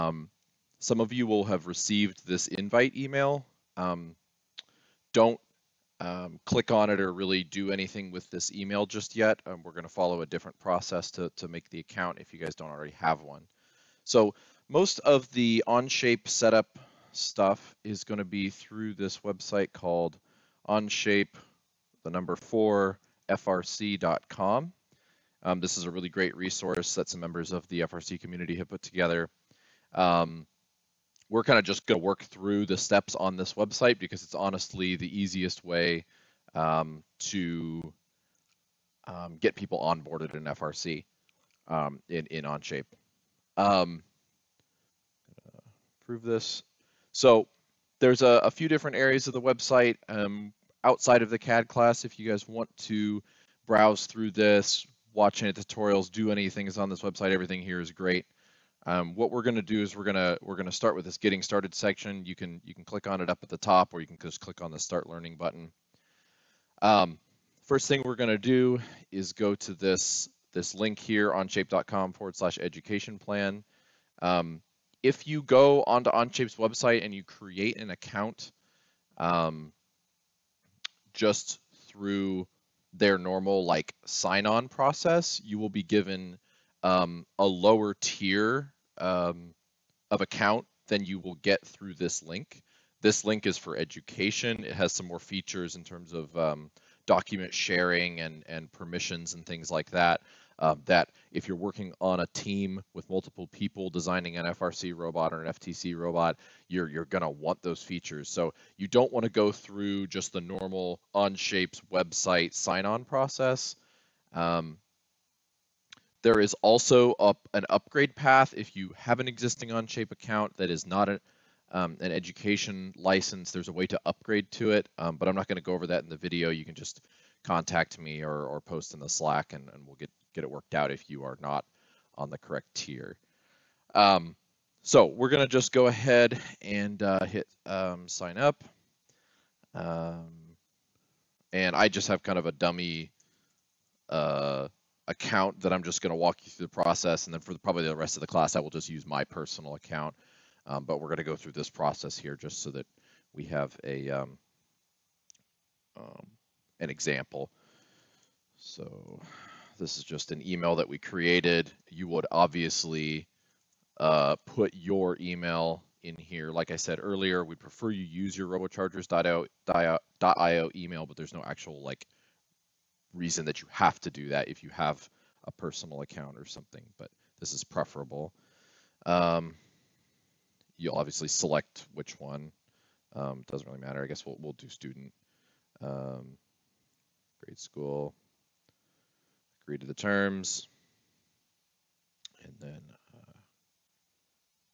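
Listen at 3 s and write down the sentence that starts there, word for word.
Um, don't um, click on it or really do anything with this email just yet.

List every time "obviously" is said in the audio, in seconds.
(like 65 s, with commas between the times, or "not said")
162 s, 180 s.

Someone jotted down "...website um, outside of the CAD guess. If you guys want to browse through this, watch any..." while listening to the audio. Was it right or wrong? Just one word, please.
wrong.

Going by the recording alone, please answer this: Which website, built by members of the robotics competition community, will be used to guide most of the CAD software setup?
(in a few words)
Onshape4FRC.com.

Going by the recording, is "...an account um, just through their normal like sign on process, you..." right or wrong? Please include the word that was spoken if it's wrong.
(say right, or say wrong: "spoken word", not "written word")
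right.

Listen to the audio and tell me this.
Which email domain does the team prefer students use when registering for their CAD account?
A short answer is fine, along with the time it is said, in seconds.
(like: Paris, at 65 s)
robochargers.io, at 168 s.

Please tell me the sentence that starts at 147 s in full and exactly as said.
And then for the, probably the rest of the class, I will just use my personal account.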